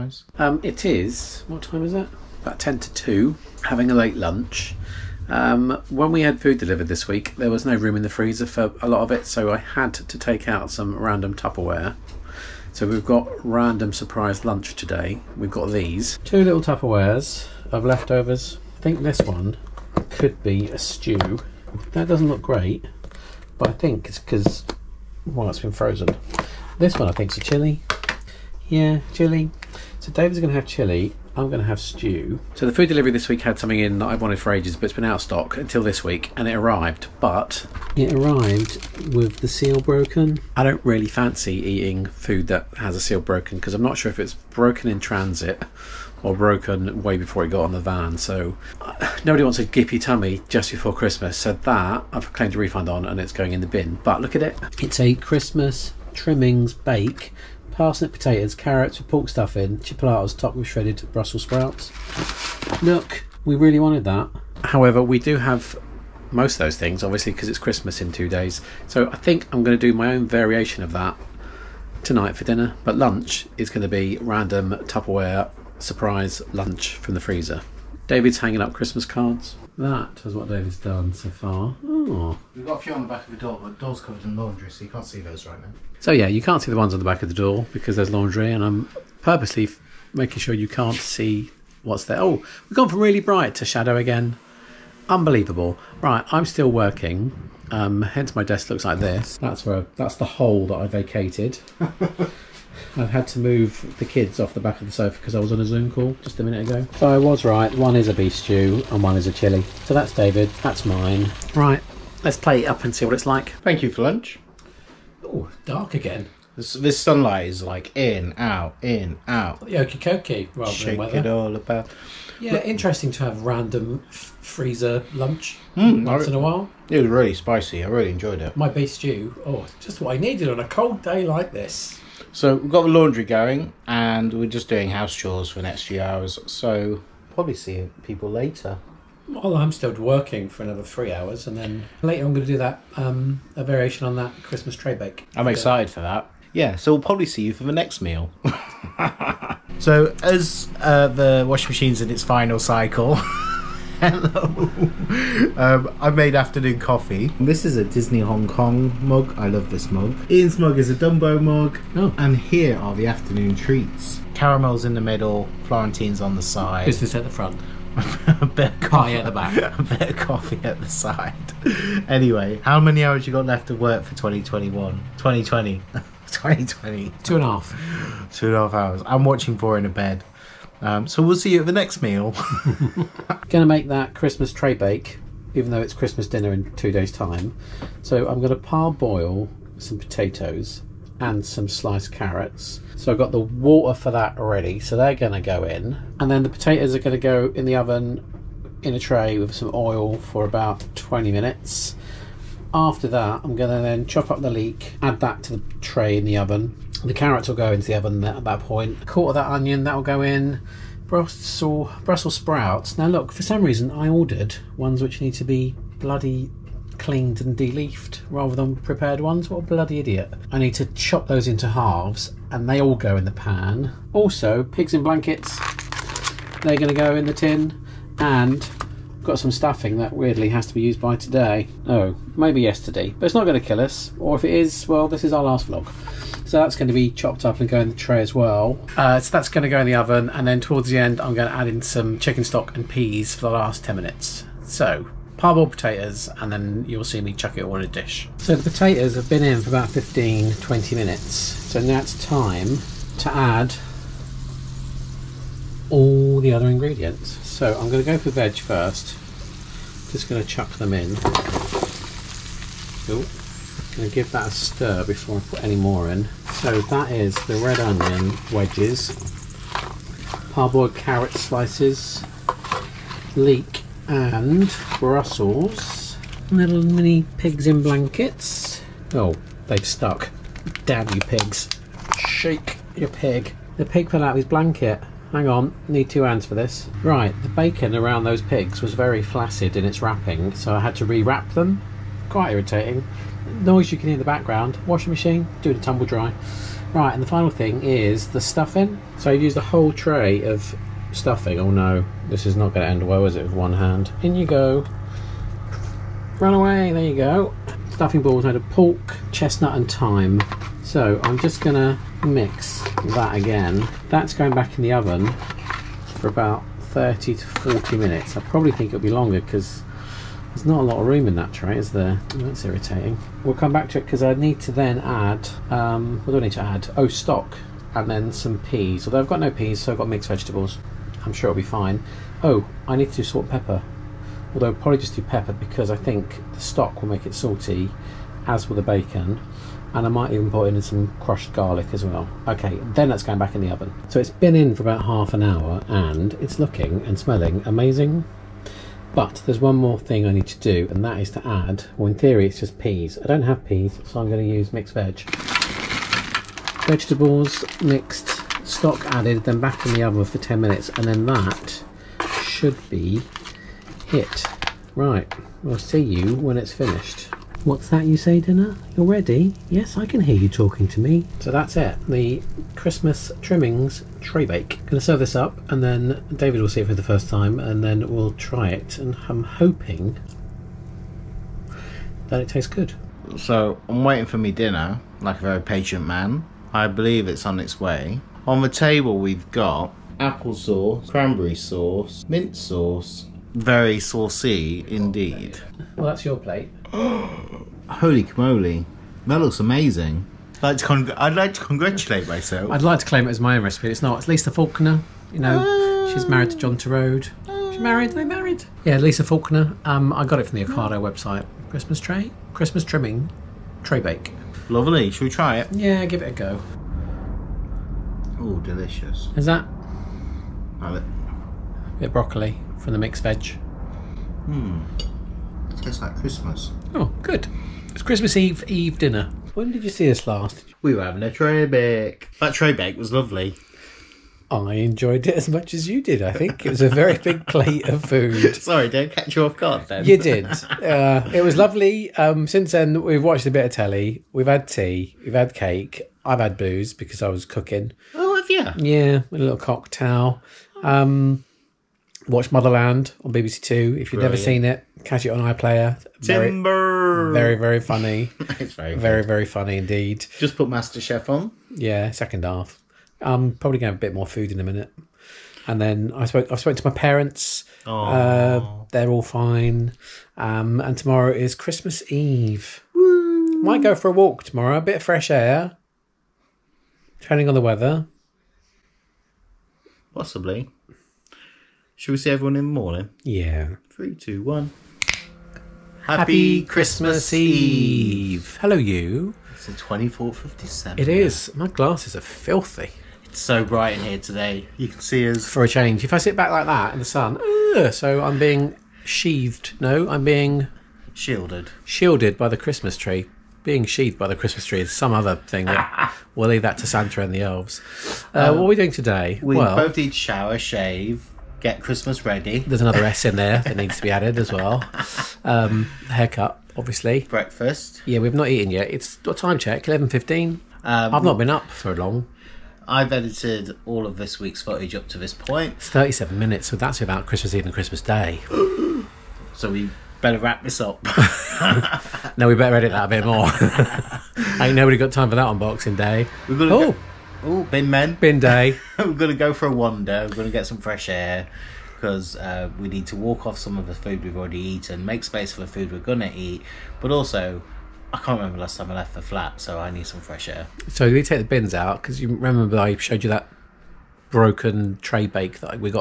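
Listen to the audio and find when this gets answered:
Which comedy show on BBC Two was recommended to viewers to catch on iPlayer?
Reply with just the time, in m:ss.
7:32.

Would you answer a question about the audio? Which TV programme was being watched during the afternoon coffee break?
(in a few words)
Four in a Bed.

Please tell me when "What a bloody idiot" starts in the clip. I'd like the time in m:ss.
3:39.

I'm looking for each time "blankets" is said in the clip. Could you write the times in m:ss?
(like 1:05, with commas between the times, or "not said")
3:45, 4:37, 4:44.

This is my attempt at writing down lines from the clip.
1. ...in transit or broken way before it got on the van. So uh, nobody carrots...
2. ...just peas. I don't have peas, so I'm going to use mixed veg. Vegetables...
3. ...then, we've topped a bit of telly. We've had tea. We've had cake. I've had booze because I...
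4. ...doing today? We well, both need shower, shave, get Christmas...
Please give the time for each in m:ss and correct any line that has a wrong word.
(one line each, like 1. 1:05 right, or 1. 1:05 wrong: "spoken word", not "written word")
1. 0:44 wrong: "wants", not "carrots"
2. 5:52 right
3. 7:22 wrong: "watched", not "topped"
4. 8:28 right.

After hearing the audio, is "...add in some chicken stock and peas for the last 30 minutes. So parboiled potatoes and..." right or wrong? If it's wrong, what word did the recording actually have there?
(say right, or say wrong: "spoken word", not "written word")
wrong: "10", not "30".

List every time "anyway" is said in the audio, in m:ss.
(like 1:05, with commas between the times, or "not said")
2:52.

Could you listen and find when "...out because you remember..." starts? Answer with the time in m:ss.
9:11.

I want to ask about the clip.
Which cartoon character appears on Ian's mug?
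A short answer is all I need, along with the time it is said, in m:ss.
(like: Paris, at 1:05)
Dumbo, at 2:40.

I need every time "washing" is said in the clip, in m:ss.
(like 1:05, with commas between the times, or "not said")
2:31, 4:54.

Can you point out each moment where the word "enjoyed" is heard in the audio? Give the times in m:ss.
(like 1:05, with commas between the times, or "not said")
2:08, 7:14.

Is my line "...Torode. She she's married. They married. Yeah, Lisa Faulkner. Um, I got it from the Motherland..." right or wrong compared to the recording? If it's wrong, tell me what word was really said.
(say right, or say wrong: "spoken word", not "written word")
wrong: "Ocado", not "Motherland".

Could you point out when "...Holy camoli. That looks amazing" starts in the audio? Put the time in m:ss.
6:36.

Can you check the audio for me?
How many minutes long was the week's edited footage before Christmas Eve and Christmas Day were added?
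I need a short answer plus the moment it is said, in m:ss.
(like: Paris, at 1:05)
37, at 8:45.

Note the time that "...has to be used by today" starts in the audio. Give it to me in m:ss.
3:50.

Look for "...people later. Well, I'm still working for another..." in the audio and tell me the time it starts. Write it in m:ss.
2:18.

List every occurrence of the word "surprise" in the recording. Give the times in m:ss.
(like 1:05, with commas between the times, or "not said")
0:13, 1:15.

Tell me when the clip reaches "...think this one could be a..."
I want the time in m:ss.
0:18.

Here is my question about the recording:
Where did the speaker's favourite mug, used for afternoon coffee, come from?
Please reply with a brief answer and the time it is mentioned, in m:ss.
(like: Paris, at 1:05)
Disney Hong Kong, at 2:37.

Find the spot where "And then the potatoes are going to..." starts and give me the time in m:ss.
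3:16.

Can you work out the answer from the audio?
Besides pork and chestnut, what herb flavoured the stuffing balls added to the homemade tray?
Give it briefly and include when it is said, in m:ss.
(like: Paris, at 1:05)
Thyme, at 5:09.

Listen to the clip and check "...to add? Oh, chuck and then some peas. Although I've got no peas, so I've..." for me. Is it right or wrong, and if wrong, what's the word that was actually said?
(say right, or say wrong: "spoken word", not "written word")
wrong: "stock", not "chuck".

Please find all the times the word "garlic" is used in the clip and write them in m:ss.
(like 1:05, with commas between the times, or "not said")
5:41.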